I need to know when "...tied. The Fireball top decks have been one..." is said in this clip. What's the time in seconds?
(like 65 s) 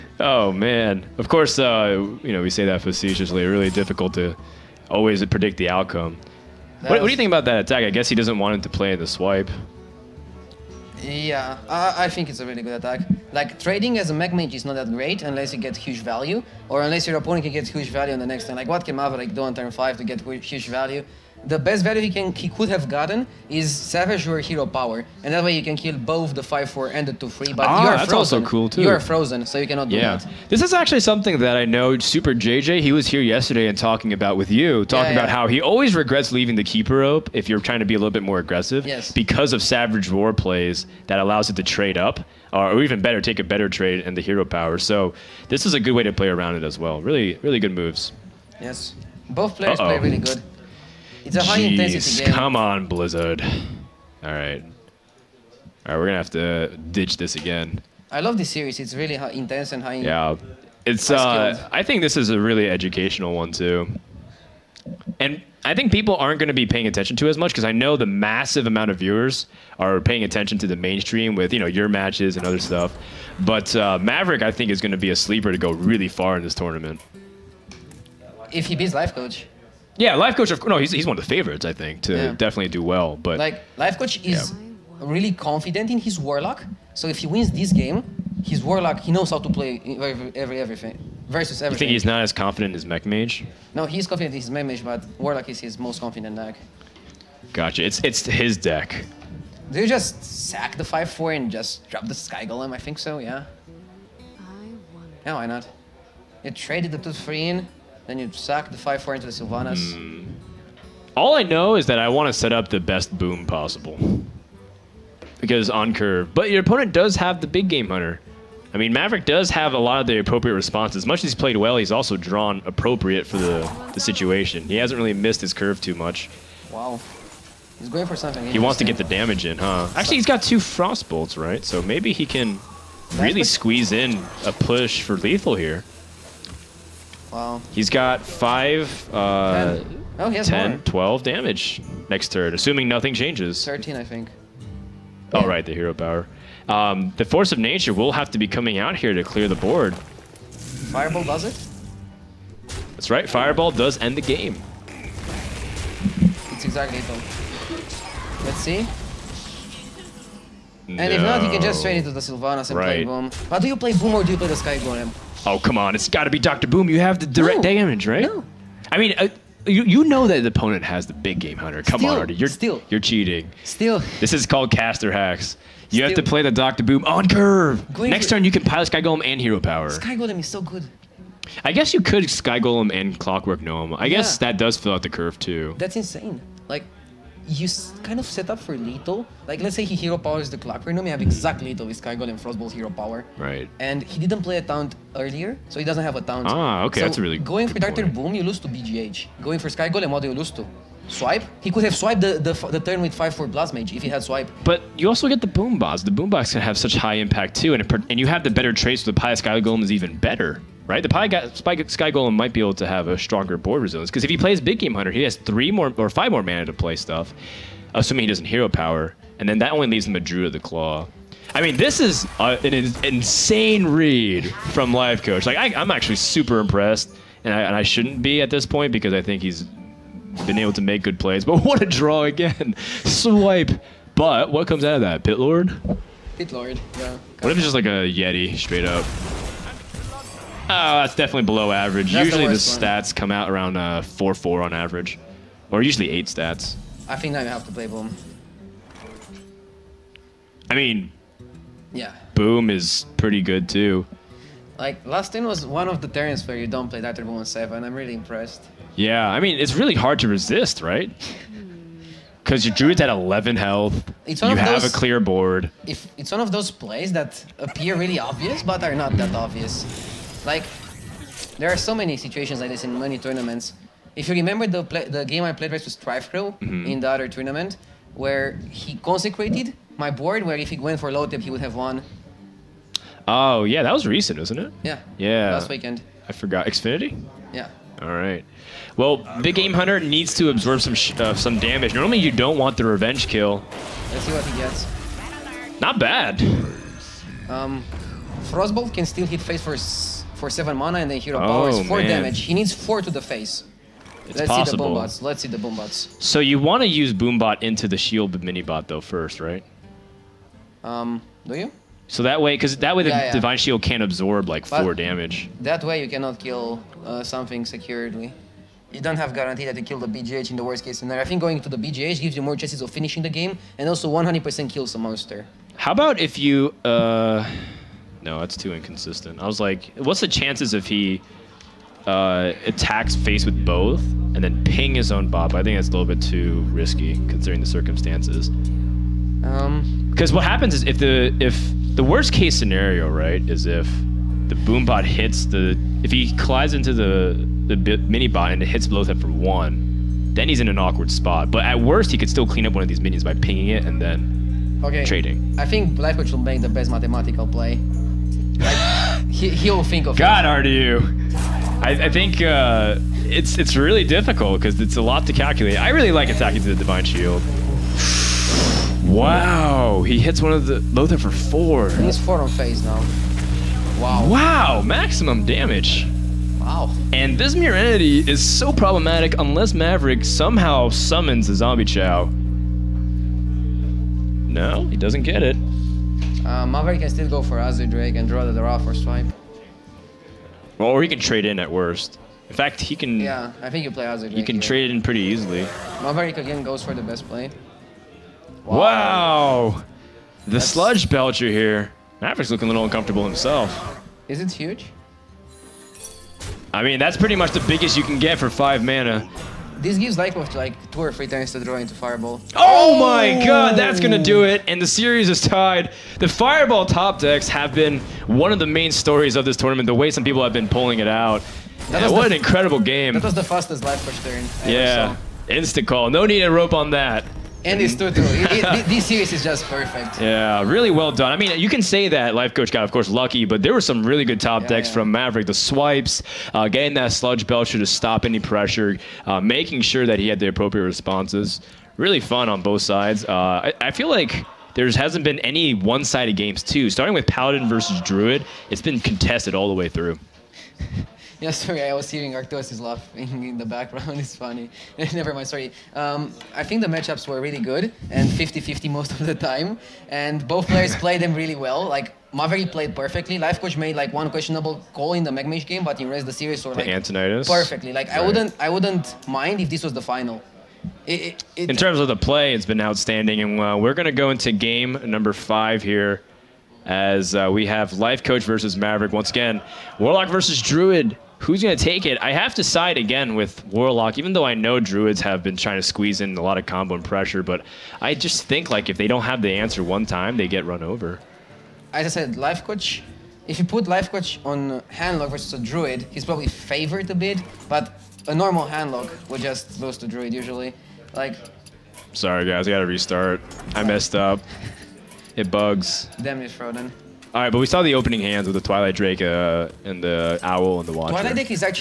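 415 s.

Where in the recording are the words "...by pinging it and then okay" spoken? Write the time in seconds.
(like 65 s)
353 s.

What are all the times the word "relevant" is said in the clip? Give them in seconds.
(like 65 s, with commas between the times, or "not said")
not said.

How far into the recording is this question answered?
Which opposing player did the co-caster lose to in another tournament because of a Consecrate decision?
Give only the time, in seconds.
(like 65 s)
275 s.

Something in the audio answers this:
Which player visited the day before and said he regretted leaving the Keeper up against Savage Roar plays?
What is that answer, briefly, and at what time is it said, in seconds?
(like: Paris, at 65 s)
Super JJ, at 31 s.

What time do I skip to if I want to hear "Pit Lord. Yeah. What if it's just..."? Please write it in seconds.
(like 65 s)
236 s.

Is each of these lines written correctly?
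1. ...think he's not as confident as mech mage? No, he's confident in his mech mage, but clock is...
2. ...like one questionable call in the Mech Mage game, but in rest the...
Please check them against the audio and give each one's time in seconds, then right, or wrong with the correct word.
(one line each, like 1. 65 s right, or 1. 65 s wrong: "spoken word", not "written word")
1. 91 s wrong: "warlock", not "clock"
2. 463 s right.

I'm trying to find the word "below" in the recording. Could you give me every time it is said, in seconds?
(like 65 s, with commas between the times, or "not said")
241 s.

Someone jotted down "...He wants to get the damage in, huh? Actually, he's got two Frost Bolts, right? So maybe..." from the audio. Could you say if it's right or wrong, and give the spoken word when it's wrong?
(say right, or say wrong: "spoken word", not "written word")
right.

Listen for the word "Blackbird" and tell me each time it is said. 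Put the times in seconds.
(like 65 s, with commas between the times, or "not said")
355 s.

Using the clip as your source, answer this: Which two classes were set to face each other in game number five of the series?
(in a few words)
Warlock versus Druid.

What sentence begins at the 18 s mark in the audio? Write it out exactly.
Like, what can Maverick do on turn 5 to get huge value?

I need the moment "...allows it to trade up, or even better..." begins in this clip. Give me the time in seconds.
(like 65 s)
41 s.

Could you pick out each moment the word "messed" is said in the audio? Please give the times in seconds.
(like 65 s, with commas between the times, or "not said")
503 s.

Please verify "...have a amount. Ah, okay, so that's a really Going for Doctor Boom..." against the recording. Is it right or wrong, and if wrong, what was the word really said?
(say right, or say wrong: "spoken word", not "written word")
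wrong: "taunt", not "amount".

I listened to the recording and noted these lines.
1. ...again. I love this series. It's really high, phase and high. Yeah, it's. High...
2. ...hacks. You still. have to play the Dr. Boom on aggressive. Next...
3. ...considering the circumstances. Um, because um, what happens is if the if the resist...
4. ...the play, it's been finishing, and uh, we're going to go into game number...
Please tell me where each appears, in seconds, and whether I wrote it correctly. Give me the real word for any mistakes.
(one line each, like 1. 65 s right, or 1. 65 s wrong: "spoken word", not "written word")
1. 57 s wrong: "intense", not "phase"
2. 175 s wrong: "curve", not "aggressive"
3. 337 s wrong: "worst", not "resist"
4. 472 s wrong: "outstanding", not "finishing".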